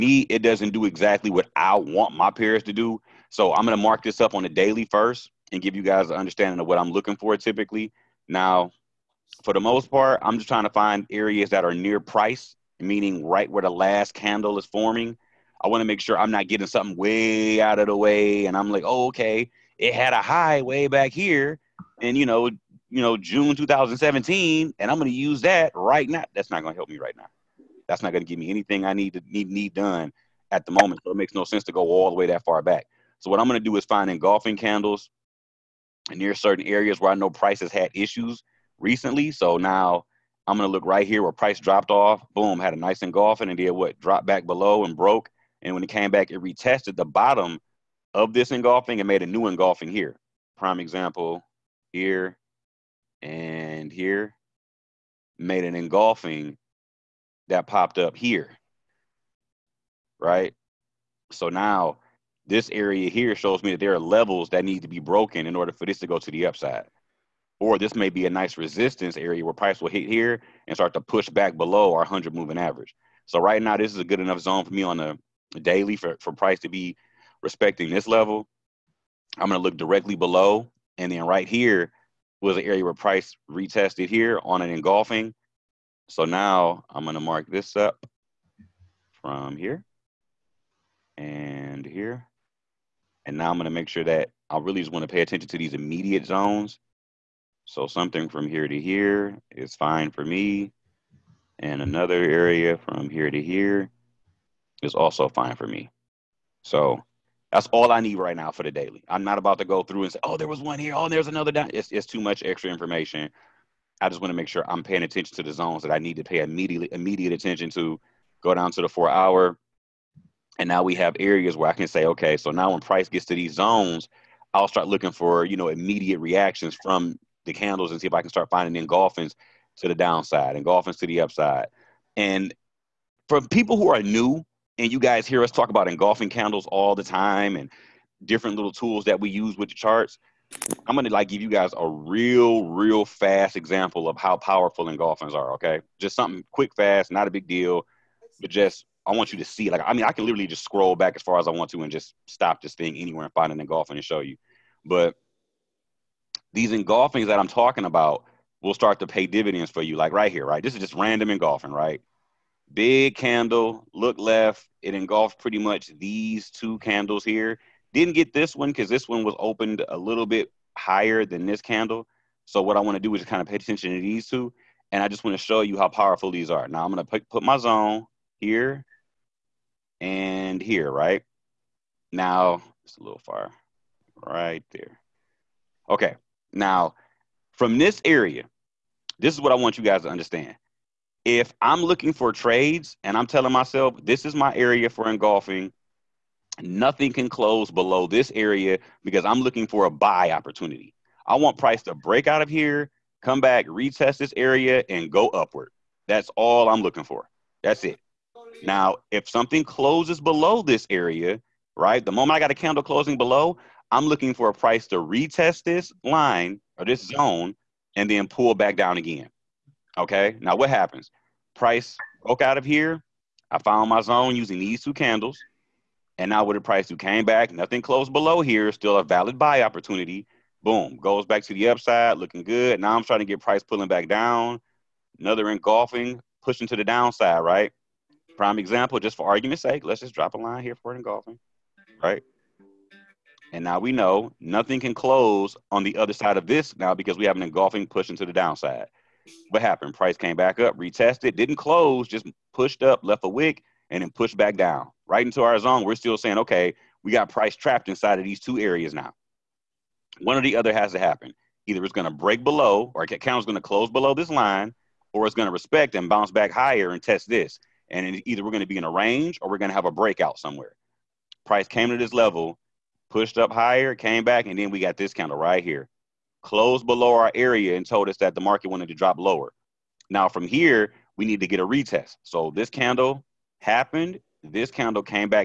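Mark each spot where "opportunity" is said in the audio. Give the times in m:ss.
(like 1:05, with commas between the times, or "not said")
3:20, 3:49.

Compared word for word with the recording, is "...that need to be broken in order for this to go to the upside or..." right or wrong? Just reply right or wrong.
right.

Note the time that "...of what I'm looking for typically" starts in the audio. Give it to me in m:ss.
0:06.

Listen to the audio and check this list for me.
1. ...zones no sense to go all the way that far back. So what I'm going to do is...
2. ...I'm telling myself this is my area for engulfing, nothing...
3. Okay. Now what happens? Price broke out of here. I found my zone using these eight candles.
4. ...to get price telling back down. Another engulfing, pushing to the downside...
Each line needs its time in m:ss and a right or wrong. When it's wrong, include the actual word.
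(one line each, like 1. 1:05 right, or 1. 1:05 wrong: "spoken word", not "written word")
1. 0:31 wrong: "makes", not "zones"
2. 3:13 right
3. 3:39 wrong: "two", not "eight"
4. 3:53 wrong: "pulling", not "telling".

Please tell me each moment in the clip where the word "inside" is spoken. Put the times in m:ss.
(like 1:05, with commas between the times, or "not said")
4:17.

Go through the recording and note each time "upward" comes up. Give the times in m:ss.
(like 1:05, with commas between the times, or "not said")
3:25.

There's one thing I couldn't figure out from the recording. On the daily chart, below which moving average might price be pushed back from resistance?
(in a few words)
100.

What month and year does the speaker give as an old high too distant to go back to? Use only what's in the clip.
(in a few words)
June 2017.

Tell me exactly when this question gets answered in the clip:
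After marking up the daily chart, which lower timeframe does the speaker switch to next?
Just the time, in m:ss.
1:58.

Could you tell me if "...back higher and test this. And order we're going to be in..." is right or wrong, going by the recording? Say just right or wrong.
wrong.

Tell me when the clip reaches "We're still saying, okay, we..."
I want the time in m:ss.
4:15.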